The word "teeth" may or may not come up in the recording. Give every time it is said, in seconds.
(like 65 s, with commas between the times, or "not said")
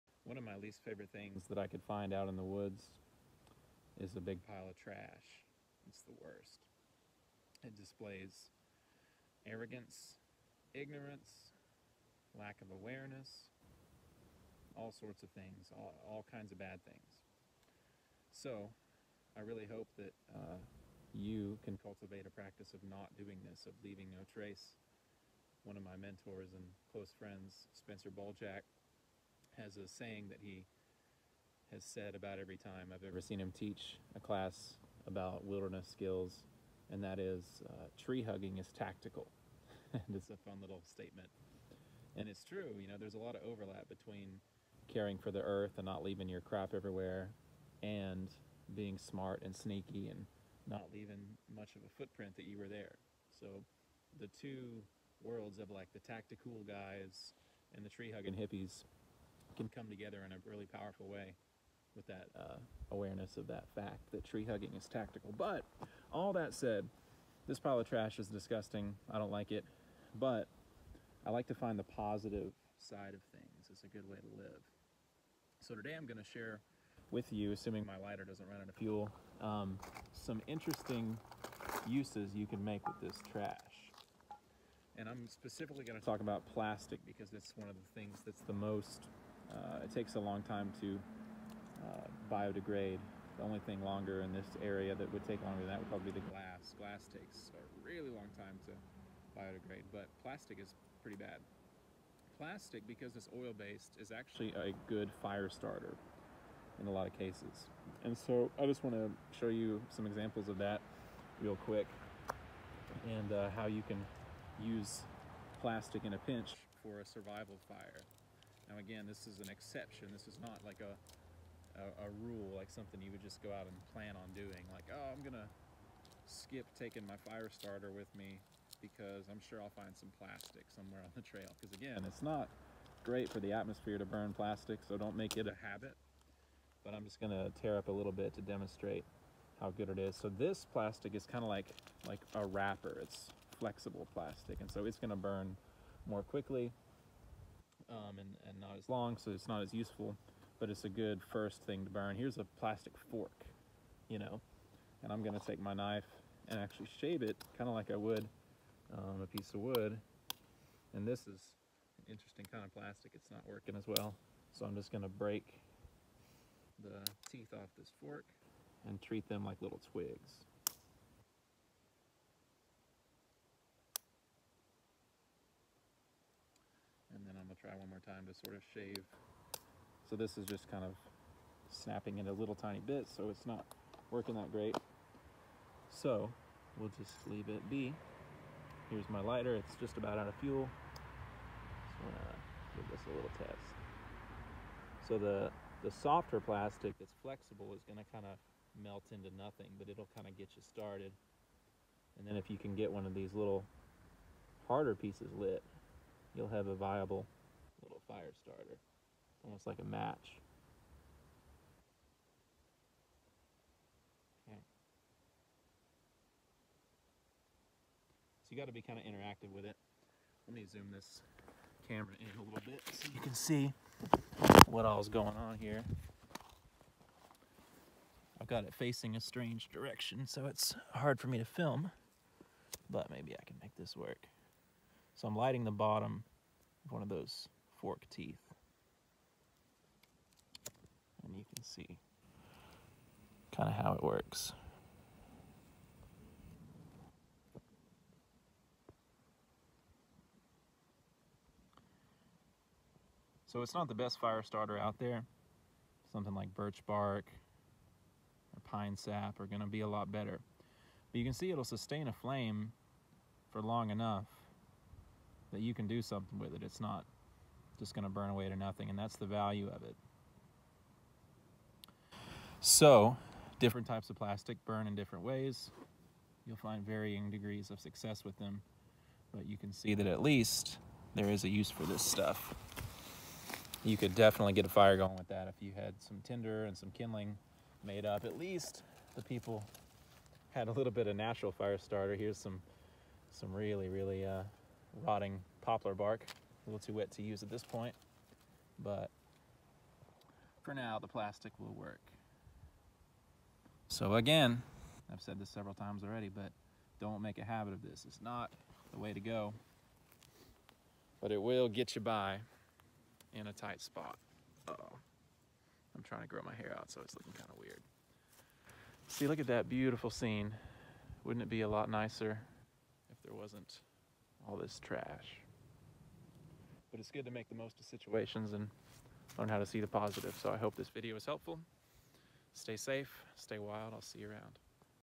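167 s, 238 s.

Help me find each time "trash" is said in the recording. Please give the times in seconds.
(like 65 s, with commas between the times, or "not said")
4 s, 67 s, 83 s, 324 s.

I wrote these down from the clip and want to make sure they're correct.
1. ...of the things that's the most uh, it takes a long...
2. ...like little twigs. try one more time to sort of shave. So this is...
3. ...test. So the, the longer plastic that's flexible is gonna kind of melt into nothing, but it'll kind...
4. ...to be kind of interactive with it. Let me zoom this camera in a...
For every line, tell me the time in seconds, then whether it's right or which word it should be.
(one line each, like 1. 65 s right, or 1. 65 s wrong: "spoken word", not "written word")
1. 87 s right
2. 169 s right
3. 193 s wrong: "softer", not "longer"
4. 218 s right.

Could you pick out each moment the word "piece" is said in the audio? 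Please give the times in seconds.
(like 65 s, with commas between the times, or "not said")
159 s, 204 s.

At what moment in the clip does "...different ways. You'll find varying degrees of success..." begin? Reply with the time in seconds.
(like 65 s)
274 s.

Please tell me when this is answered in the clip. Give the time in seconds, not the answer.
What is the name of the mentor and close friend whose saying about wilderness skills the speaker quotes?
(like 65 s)
27 s.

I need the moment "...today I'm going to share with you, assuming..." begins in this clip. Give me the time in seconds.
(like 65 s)
75 s.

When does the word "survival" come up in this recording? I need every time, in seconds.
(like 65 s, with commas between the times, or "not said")
117 s.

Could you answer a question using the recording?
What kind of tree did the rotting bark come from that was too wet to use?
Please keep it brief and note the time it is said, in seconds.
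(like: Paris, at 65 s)
poplar, at 295 s.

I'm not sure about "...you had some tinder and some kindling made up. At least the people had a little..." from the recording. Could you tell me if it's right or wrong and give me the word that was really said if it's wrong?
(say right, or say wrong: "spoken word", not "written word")
right.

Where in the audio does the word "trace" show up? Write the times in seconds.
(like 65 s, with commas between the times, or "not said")
24 s.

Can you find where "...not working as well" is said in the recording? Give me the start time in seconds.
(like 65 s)
163 s.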